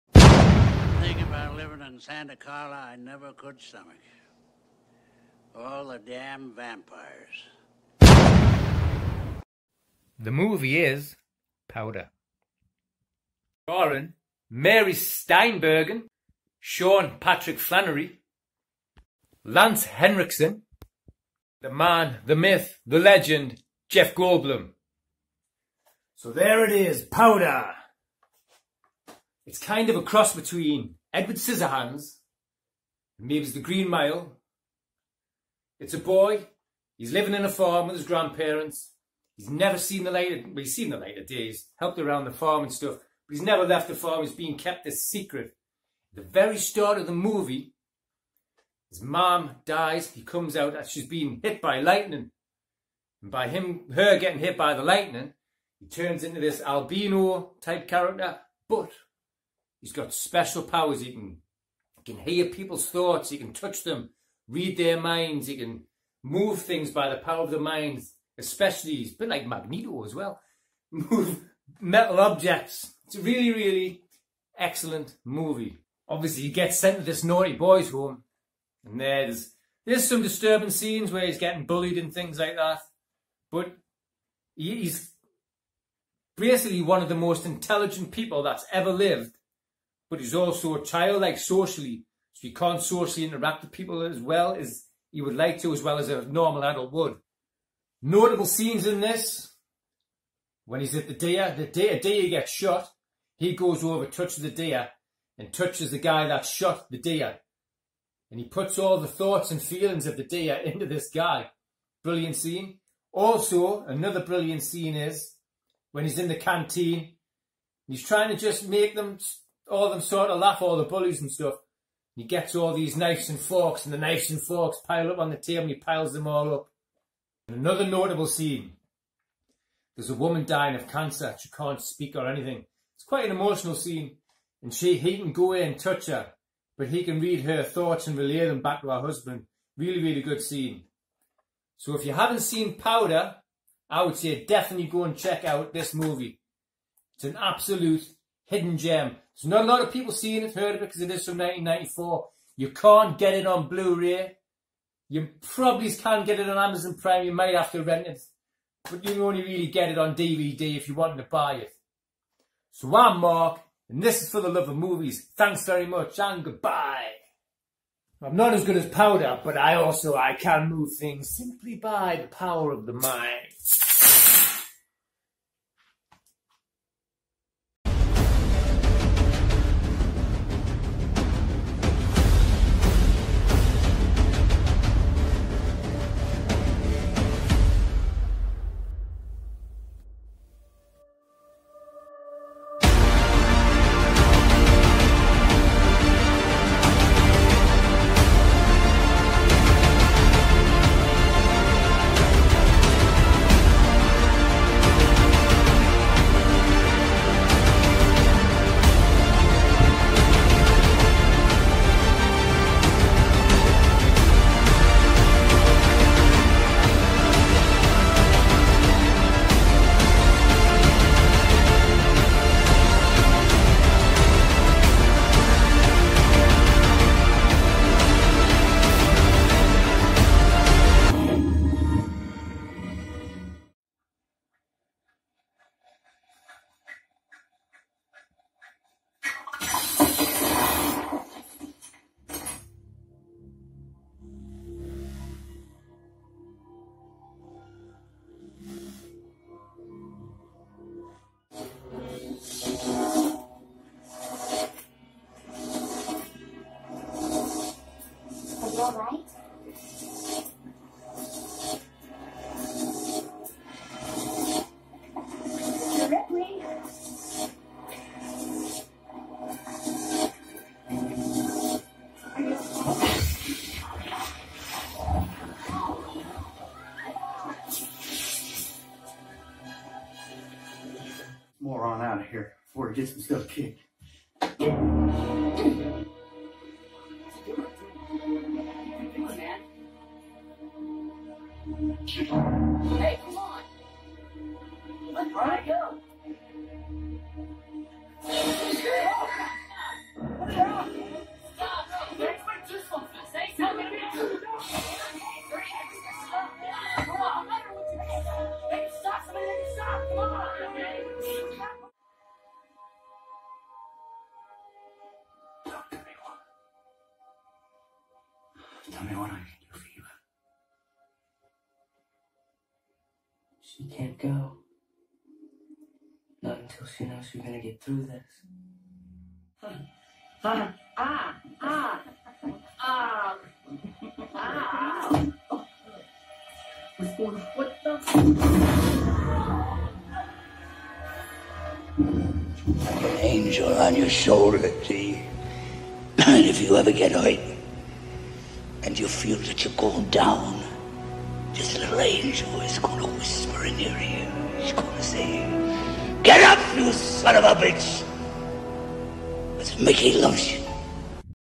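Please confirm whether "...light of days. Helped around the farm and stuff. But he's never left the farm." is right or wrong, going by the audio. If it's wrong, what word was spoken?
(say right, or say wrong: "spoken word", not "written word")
right.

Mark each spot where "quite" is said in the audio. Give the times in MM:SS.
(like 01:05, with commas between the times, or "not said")
02:13.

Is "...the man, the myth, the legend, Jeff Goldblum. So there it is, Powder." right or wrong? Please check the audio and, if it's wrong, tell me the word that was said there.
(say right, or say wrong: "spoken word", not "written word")
right.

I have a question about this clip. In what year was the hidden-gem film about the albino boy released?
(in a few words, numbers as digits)
1994.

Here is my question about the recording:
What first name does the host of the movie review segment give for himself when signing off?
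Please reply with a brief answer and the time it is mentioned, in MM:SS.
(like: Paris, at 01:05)
Mark, at 02:43.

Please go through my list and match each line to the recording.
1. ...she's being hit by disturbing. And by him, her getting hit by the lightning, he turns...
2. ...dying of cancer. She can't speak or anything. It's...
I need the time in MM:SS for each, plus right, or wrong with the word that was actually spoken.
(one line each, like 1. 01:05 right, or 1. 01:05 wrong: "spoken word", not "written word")
1. 00:50 wrong: "lightning", not "disturbing"
2. 02:10 right.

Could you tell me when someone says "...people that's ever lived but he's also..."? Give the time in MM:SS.
01:28.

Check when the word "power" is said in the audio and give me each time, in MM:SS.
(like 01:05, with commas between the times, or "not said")
01:00, 01:07, 02:52.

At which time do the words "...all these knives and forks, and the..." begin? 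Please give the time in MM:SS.
02:02.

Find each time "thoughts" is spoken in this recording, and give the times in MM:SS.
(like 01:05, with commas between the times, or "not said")
01:02, 01:49, 02:17.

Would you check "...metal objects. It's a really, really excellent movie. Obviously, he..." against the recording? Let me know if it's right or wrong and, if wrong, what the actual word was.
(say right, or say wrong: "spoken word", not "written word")
right.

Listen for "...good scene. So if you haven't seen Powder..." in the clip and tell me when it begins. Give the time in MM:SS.
02:20.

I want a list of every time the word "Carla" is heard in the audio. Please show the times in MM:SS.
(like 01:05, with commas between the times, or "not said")
00:02.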